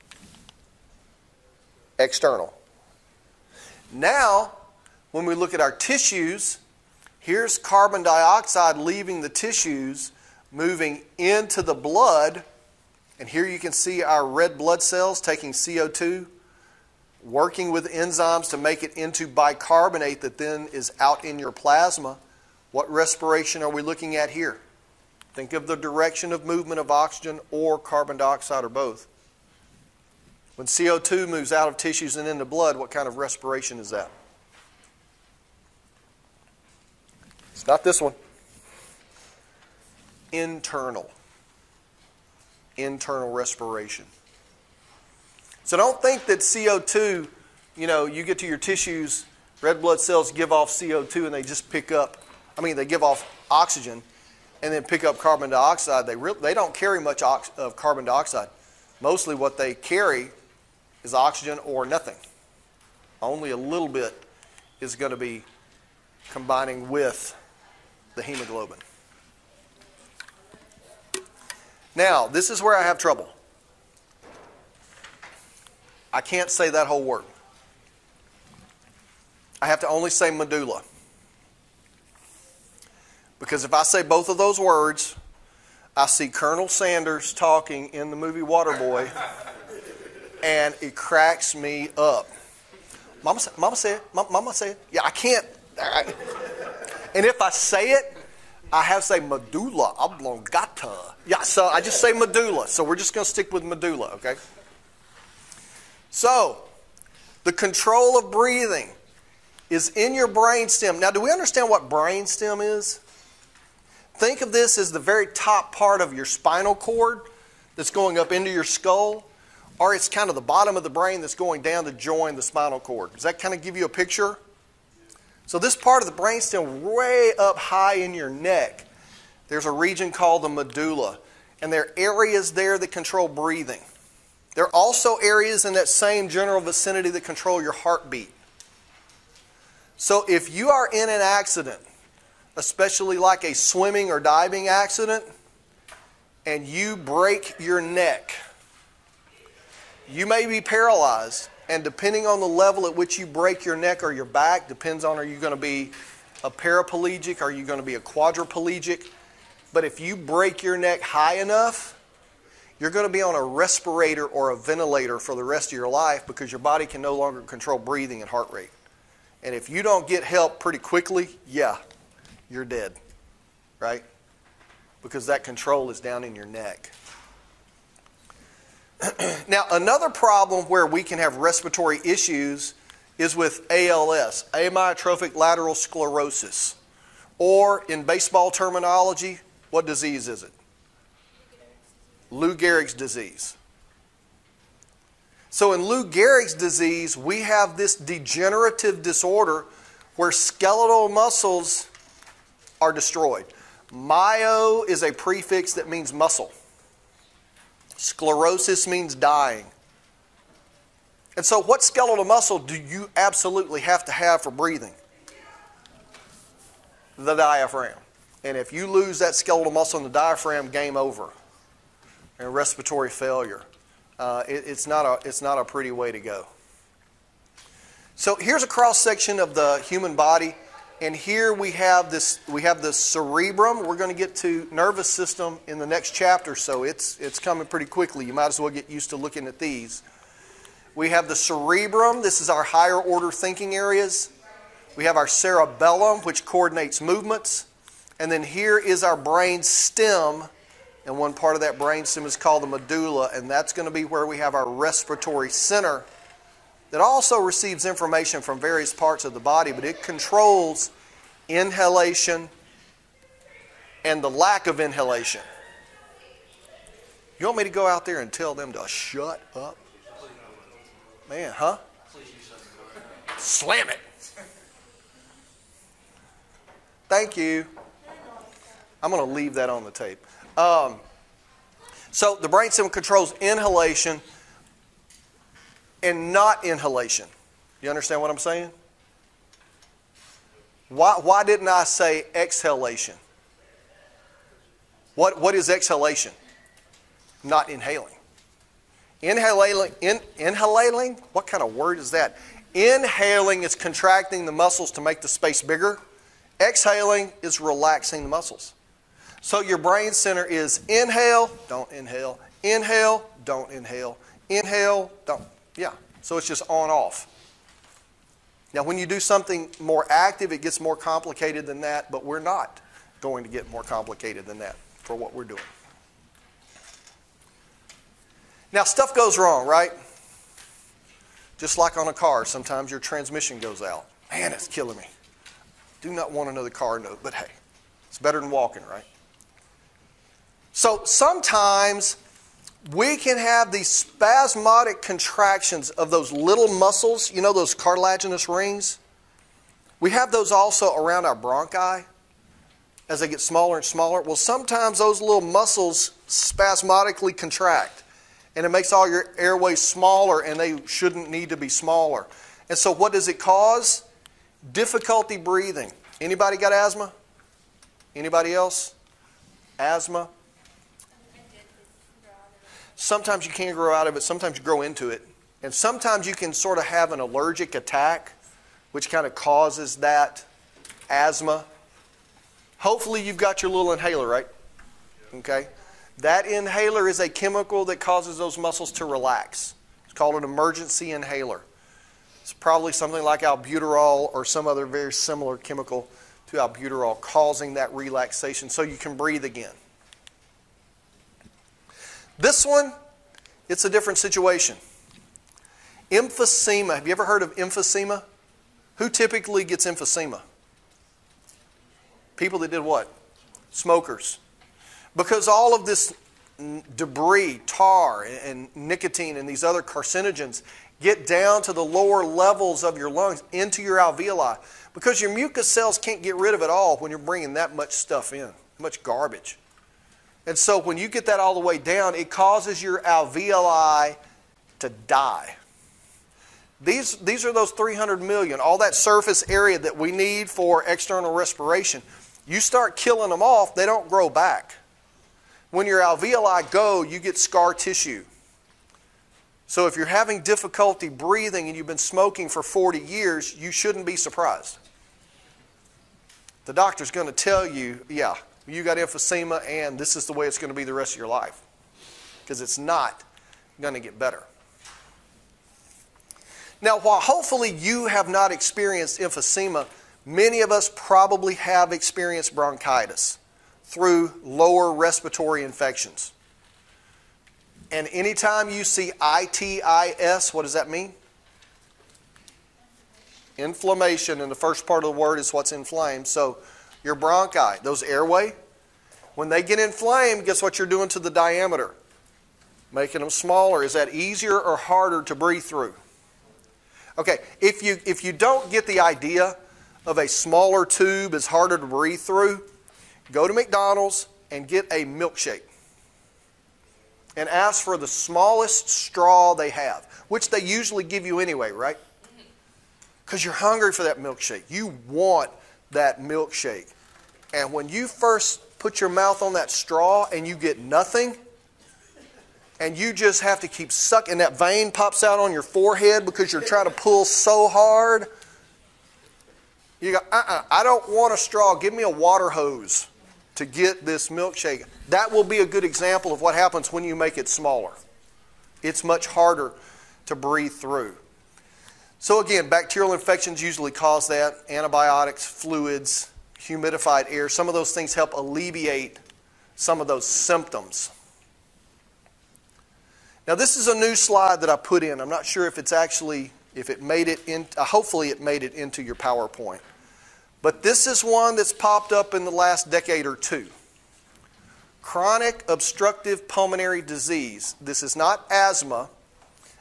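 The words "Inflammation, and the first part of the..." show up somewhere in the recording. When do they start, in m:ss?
8:03.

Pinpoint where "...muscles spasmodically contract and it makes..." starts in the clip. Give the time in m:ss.
5:55.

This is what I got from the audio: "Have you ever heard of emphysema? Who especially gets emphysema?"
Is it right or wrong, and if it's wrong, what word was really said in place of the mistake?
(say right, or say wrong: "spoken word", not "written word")
wrong: "typically", not "especially".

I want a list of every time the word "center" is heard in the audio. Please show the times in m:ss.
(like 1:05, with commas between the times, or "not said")
4:15, 5:10.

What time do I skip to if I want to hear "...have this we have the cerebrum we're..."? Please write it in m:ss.
3:51.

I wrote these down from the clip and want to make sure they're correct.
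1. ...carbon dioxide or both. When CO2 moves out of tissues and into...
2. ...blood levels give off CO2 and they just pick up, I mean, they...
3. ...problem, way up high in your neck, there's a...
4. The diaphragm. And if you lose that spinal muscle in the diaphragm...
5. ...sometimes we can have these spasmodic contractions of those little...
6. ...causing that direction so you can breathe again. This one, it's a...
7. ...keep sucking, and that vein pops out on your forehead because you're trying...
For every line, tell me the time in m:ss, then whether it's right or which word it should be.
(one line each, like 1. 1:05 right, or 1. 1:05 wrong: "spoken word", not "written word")
1. 0:27 right
2. 0:49 wrong: "cells", not "levels"
3. 2:06 wrong: "brainstem", not "problem"
4. 3:37 wrong: "skeletal", not "spinal"
5. 5:41 right
6. 6:37 wrong: "relaxation", not "direction"
7. 8:43 right.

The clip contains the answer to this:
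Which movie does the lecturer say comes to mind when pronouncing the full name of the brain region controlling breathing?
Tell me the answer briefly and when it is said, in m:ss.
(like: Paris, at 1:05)
Waterboy, at 1:28.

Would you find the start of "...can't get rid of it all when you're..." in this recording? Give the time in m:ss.
7:05.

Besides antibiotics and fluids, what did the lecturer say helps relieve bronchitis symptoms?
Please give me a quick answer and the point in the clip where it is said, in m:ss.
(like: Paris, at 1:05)
Humidified air, at 9:06.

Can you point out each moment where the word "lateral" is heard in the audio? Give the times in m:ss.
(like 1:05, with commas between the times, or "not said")
3:05.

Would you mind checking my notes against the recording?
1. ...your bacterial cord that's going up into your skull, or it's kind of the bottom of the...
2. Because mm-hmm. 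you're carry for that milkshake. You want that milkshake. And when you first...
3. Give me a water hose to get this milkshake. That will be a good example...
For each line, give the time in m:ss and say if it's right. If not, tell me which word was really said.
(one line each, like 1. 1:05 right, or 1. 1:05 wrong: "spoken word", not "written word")
1. 1:56 wrong: "spinal", not "bacterial"
2. 8:33 wrong: "hungry", not "carry"
3. 8:51 right.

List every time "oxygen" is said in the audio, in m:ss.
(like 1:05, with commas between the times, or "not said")
0:26, 0:53, 1:01.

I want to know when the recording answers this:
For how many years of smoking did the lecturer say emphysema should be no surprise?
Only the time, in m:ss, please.
7:32.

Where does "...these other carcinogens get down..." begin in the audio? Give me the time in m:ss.
6:59.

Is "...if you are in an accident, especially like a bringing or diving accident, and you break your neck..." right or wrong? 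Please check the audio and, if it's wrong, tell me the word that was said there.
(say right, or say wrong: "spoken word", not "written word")
wrong: "swimming", not "bringing".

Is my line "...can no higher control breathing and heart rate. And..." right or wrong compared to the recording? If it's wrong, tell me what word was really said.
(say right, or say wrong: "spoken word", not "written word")
wrong: "longer", not "higher".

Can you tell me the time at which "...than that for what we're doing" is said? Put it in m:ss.
5:24.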